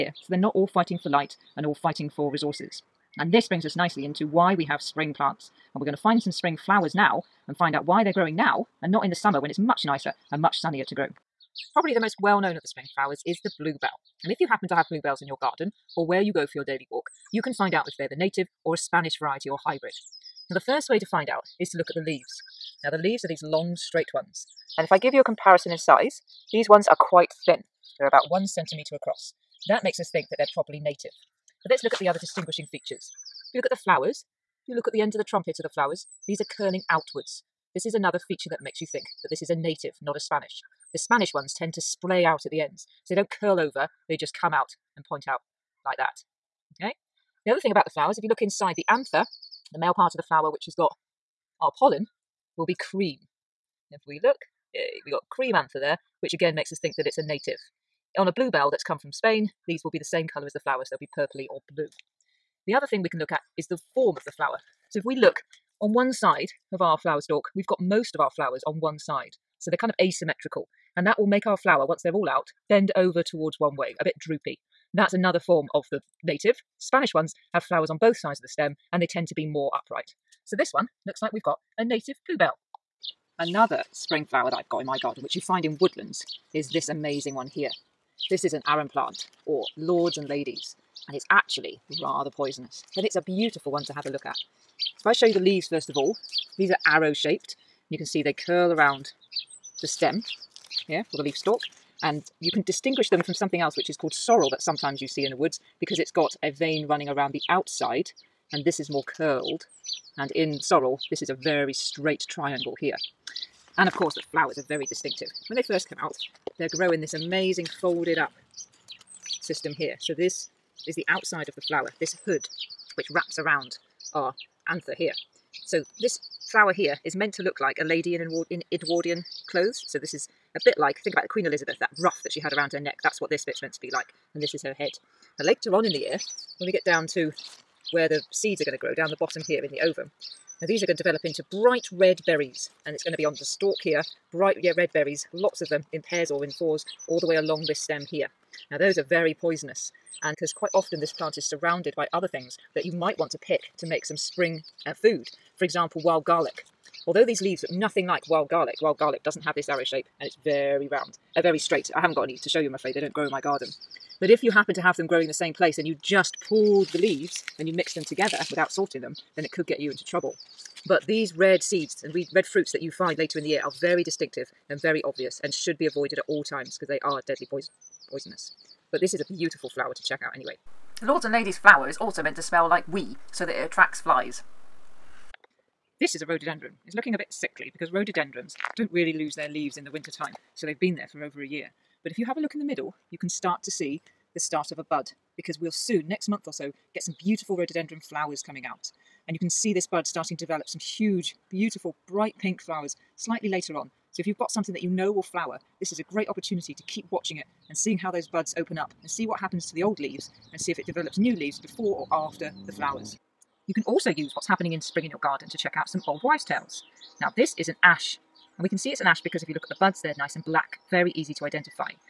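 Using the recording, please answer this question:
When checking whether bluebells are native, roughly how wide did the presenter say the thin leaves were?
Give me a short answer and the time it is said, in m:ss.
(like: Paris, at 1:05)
1 centimetre, at 0:28.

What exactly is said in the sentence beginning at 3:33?
You can also use what's happening in spring in your garden to check out some old wives' tales.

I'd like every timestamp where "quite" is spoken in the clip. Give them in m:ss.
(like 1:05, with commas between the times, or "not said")
0:26, 2:30.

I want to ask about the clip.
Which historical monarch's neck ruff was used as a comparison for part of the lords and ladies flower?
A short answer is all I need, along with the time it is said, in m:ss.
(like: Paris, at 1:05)
Queen Elizabeth, at 2:11.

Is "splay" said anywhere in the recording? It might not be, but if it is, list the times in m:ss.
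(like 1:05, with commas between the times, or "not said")
0:41.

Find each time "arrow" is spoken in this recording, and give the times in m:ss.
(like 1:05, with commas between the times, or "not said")
1:36, 2:39.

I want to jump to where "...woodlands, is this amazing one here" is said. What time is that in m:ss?
1:25.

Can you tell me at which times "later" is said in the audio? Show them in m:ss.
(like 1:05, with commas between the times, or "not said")
2:15, 2:53, 3:23.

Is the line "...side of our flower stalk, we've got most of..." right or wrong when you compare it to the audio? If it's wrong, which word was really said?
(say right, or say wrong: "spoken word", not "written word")
right.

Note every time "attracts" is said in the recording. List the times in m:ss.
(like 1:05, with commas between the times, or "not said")
3:03.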